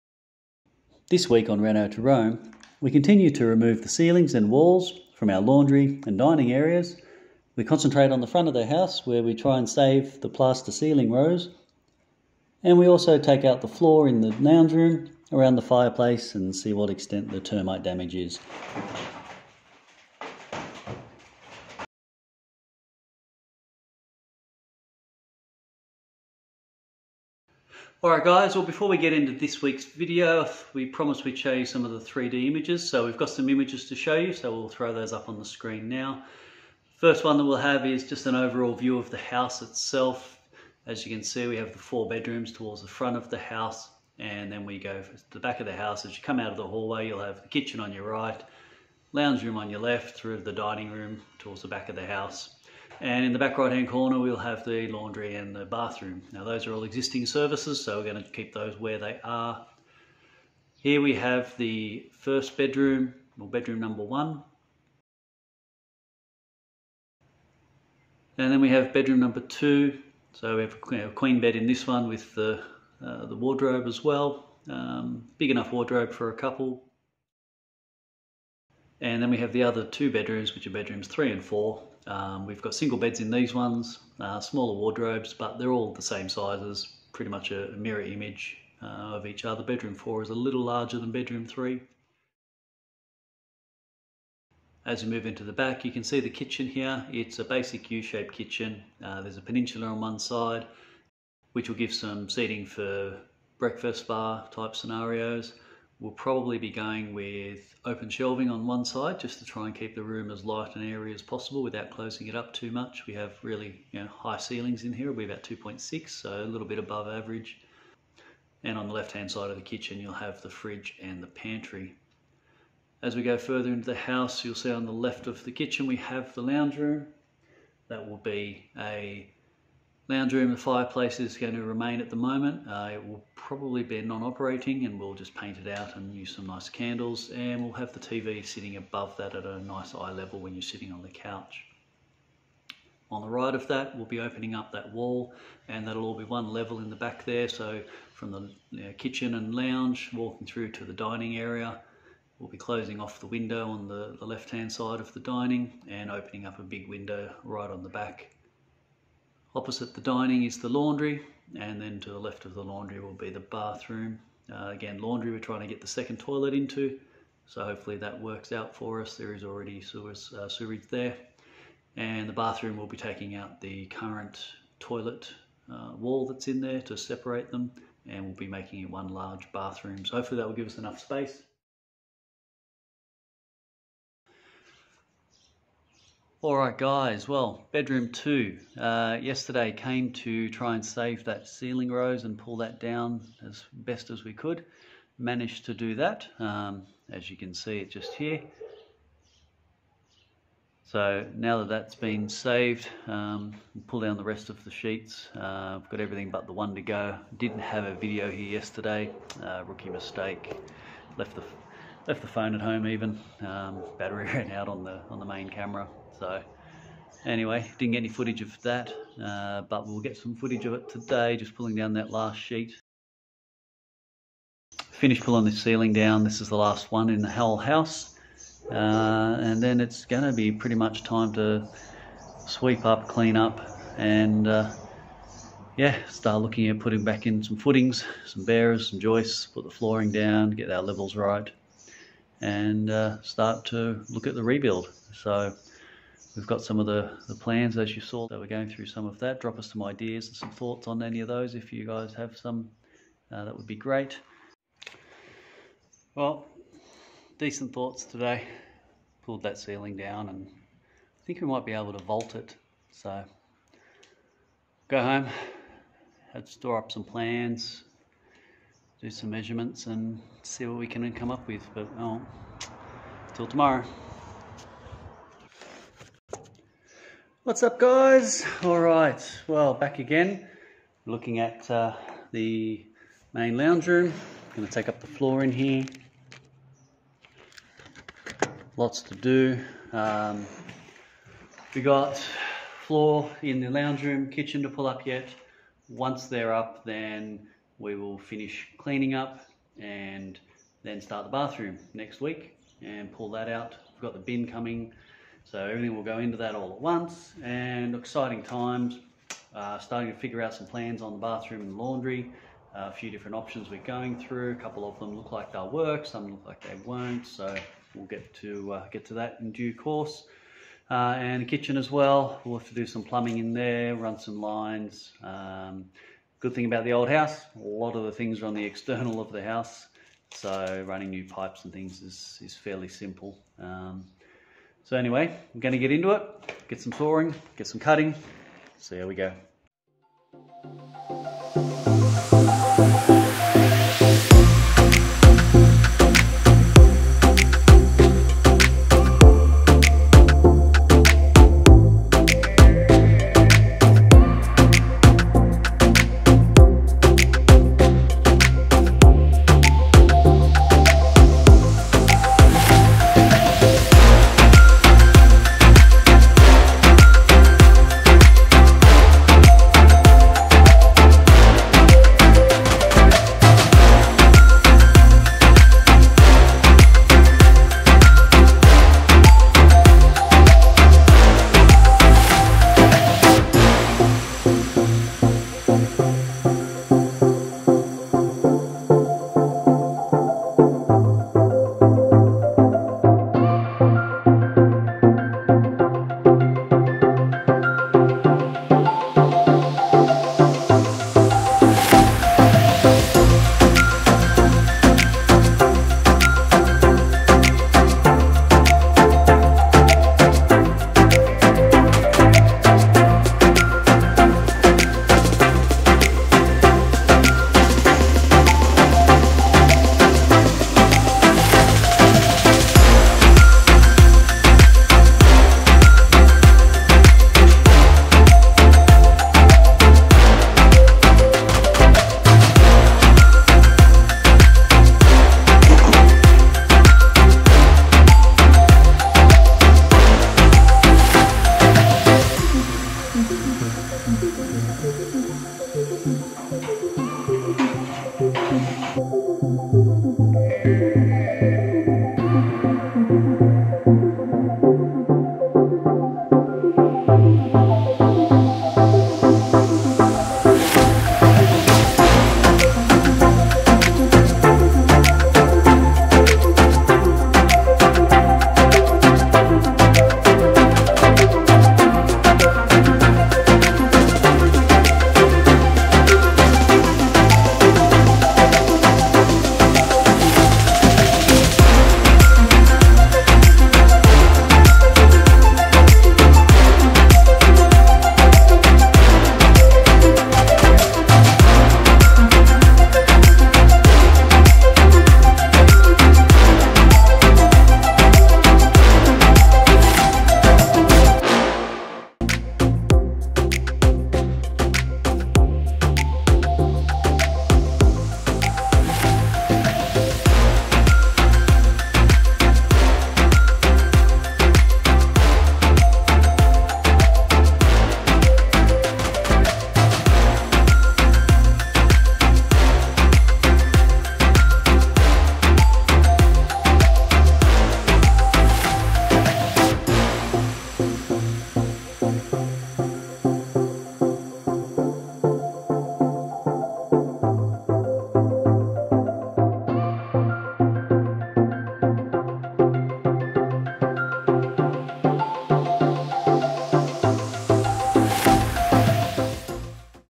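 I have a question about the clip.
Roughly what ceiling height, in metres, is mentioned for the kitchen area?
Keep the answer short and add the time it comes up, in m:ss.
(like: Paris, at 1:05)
2.6, at 1:55.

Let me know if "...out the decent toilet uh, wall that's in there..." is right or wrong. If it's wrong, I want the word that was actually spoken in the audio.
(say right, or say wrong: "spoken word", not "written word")
wrong: "current", not "decent".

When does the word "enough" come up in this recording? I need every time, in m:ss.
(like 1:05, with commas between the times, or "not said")
1:15, 3:00.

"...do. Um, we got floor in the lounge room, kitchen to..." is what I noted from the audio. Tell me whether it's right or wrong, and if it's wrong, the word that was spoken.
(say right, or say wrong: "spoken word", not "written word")
right.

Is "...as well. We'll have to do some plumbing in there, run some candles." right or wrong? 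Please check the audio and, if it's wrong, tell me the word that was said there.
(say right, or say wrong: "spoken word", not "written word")
wrong: "lines", not "candles".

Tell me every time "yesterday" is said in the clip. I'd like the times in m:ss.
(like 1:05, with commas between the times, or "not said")
3:09, 3:28.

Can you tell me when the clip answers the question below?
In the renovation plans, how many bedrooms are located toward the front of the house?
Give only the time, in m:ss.
0:41.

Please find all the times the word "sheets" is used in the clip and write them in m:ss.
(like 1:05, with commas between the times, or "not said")
3:24, 3:42.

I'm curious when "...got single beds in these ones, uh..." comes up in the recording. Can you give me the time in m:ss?
1:22.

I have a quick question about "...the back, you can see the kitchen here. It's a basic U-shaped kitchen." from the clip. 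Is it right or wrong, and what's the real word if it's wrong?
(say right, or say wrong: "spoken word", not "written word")
right.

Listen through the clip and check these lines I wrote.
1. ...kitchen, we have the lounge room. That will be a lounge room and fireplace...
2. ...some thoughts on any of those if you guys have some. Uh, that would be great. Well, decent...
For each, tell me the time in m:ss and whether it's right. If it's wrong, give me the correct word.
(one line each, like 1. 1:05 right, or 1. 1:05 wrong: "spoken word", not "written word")
1. 2:05 right
2. 4:10 right.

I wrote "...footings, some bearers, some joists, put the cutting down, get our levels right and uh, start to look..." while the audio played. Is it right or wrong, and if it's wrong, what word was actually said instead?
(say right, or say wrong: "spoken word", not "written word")
wrong: "flooring", not "cutting".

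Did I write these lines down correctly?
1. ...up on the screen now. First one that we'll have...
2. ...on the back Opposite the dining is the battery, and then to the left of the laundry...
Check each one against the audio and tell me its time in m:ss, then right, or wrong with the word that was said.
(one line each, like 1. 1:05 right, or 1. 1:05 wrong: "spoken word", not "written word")
1. 0:35 right
2. 2:37 wrong: "laundry", not "battery".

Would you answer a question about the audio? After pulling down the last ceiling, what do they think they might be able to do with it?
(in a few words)
Vault it.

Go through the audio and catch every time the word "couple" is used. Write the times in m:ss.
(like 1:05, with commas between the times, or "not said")
1:16, 5:14.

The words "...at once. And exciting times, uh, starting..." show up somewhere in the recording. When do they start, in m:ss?
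5:06.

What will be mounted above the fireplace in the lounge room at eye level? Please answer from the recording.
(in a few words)
The TV.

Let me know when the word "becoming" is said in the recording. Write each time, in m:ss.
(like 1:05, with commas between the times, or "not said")
not said.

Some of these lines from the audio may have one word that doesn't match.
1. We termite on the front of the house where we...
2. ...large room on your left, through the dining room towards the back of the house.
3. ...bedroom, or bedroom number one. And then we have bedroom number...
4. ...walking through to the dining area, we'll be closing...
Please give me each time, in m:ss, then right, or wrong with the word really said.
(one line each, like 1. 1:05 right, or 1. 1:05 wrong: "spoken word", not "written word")
1. 0:07 wrong: "concentrate", not "termite"
2. 0:49 wrong: "lounge", not "large"
3. 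1:02 right
4. 2:30 right.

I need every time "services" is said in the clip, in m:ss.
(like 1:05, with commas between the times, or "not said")
0:57.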